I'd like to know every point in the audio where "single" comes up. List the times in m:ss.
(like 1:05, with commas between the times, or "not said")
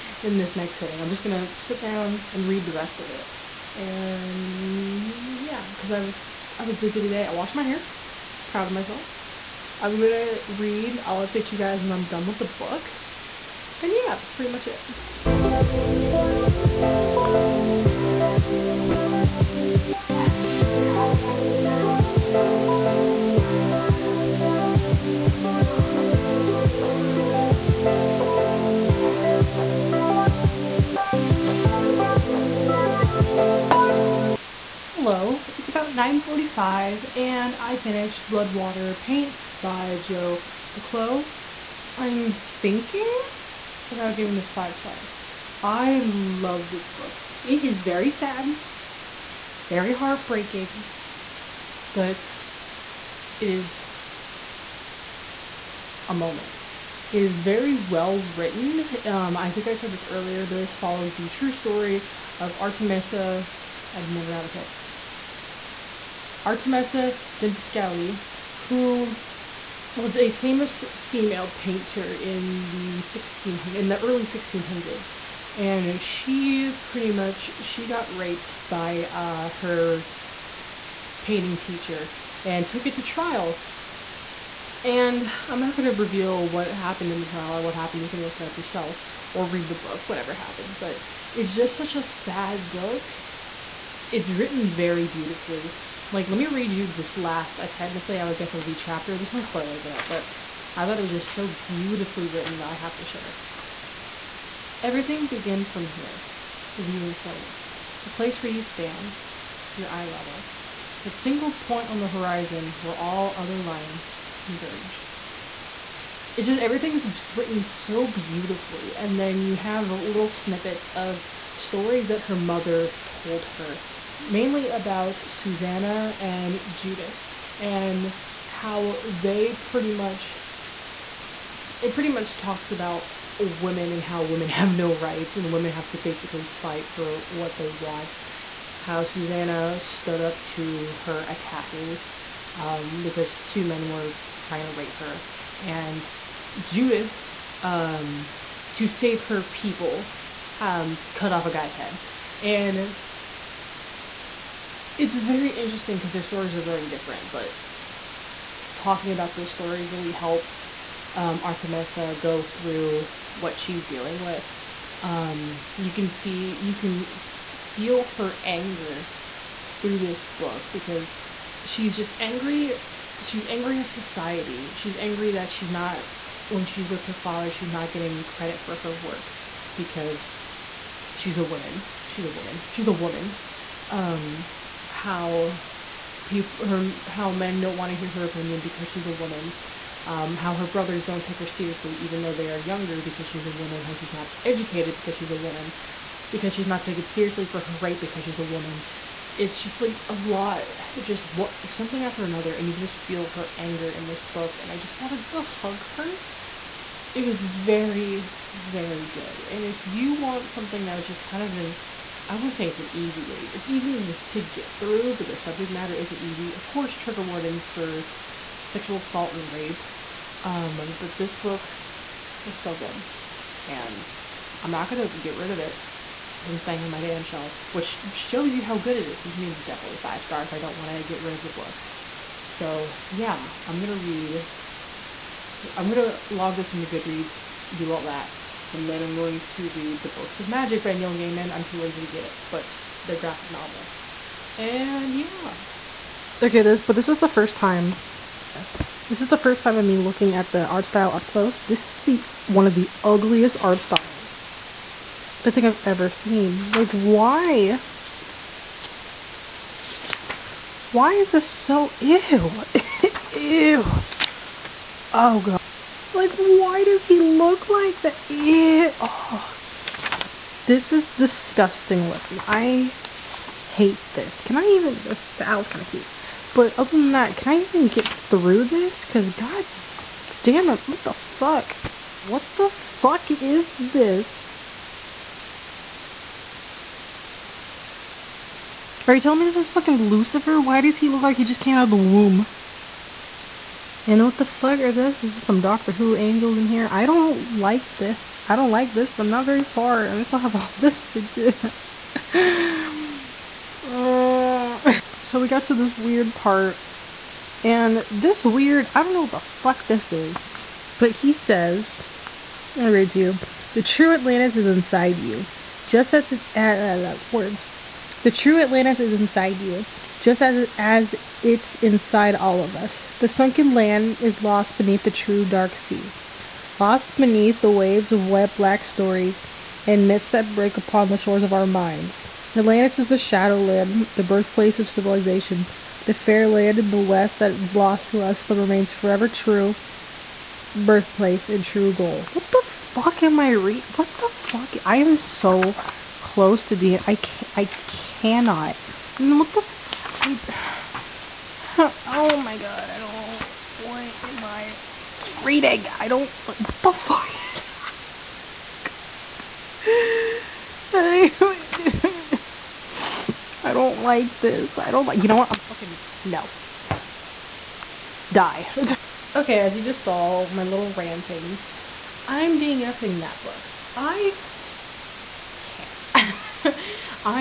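1:51.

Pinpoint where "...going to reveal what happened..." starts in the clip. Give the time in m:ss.
1:25.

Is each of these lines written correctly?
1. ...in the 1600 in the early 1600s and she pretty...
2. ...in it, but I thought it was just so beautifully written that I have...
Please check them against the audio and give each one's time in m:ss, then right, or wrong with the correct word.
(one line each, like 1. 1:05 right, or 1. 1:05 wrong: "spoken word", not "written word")
1. 1:12 right
2. 1:39 right.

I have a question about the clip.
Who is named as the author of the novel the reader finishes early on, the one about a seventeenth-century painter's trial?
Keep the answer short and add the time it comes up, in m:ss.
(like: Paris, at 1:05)
Joy McCullough, at 0:40.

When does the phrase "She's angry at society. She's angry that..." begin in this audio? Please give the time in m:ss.
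2:53.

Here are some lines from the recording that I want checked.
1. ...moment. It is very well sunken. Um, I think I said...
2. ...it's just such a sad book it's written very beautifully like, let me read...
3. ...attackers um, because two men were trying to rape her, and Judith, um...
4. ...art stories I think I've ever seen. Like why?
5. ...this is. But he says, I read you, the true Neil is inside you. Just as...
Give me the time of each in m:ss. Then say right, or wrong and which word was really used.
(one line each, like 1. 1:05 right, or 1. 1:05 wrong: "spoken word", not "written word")
1. 0:56 wrong: "written", not "sunken"
2. 1:31 right
3. 2:21 right
4. 4:13 wrong: "styles", not "stories"
5. 5:09 wrong: "Atlantis", not "Neil".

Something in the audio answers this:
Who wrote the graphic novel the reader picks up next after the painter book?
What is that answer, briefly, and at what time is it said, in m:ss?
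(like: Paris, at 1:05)
Neil Gaiman, at 4:00.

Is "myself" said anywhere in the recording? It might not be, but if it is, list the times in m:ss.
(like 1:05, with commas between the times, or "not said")
0:08.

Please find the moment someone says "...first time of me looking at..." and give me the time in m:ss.
4:09.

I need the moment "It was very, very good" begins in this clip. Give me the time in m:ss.
3:27.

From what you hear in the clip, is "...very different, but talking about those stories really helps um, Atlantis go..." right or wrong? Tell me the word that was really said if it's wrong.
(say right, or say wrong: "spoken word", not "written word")
wrong: "Artemisa", not "Atlantis".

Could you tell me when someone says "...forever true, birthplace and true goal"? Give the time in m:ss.
5:38.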